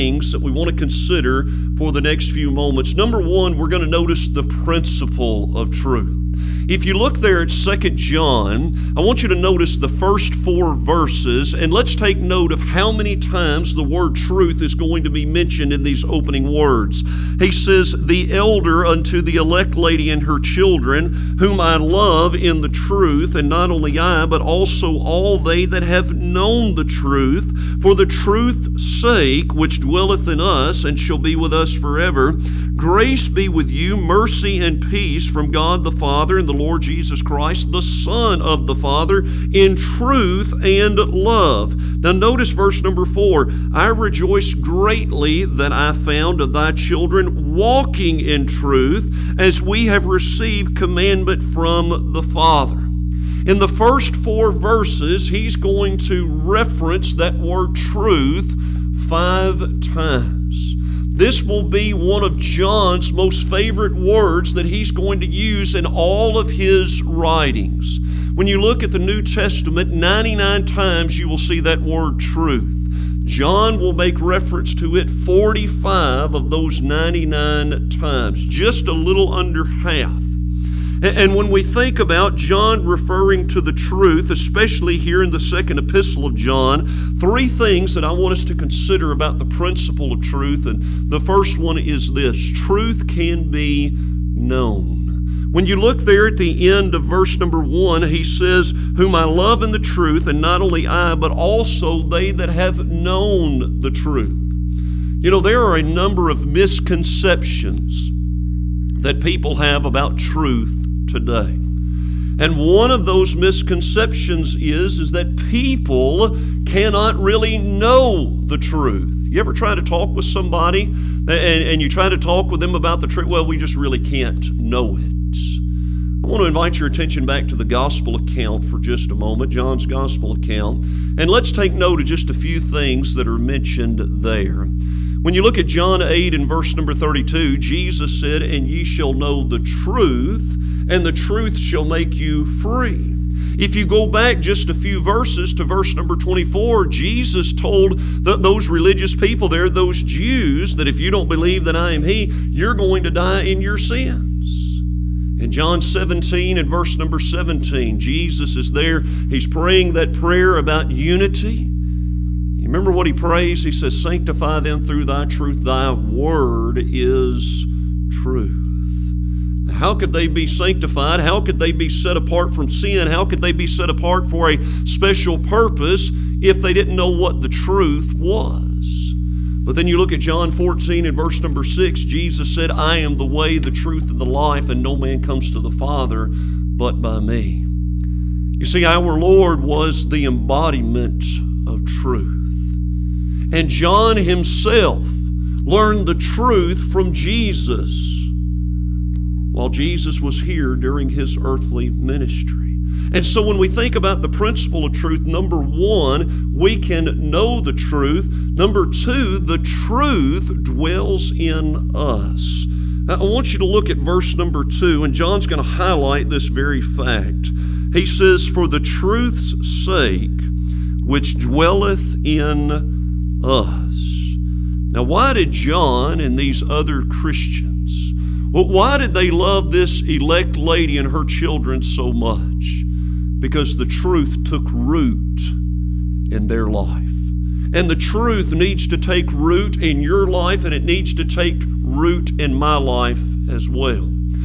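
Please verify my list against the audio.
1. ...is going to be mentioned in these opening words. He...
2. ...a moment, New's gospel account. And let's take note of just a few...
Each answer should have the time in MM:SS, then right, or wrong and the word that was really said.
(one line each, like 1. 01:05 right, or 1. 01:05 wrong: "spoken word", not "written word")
1. 00:14 right
2. 02:09 wrong: "John", not "New".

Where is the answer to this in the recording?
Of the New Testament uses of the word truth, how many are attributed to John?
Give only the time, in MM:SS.
01:15.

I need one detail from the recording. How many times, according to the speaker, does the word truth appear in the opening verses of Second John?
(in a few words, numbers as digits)
5.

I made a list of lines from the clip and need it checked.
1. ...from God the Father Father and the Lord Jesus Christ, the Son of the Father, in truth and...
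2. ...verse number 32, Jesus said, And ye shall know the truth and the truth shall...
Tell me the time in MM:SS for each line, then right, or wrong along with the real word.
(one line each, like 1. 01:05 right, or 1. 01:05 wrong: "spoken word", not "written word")
1. 00:35 right
2. 02:16 right.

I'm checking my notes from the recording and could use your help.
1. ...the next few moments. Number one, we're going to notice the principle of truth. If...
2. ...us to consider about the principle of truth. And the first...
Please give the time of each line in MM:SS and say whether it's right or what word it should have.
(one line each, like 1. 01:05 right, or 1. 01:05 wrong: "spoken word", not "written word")
1. 00:01 right
2. 01:28 right.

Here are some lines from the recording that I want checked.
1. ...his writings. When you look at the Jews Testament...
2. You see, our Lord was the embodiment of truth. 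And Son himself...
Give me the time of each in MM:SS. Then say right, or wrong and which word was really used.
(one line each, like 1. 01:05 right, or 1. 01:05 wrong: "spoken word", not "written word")
1. 01:06 wrong: "New", not "Jews"
2. 03:08 wrong: "John", not "Son".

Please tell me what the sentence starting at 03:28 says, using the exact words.
Number two, the truth dwells in us.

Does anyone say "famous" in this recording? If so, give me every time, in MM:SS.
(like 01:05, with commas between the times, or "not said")
not said.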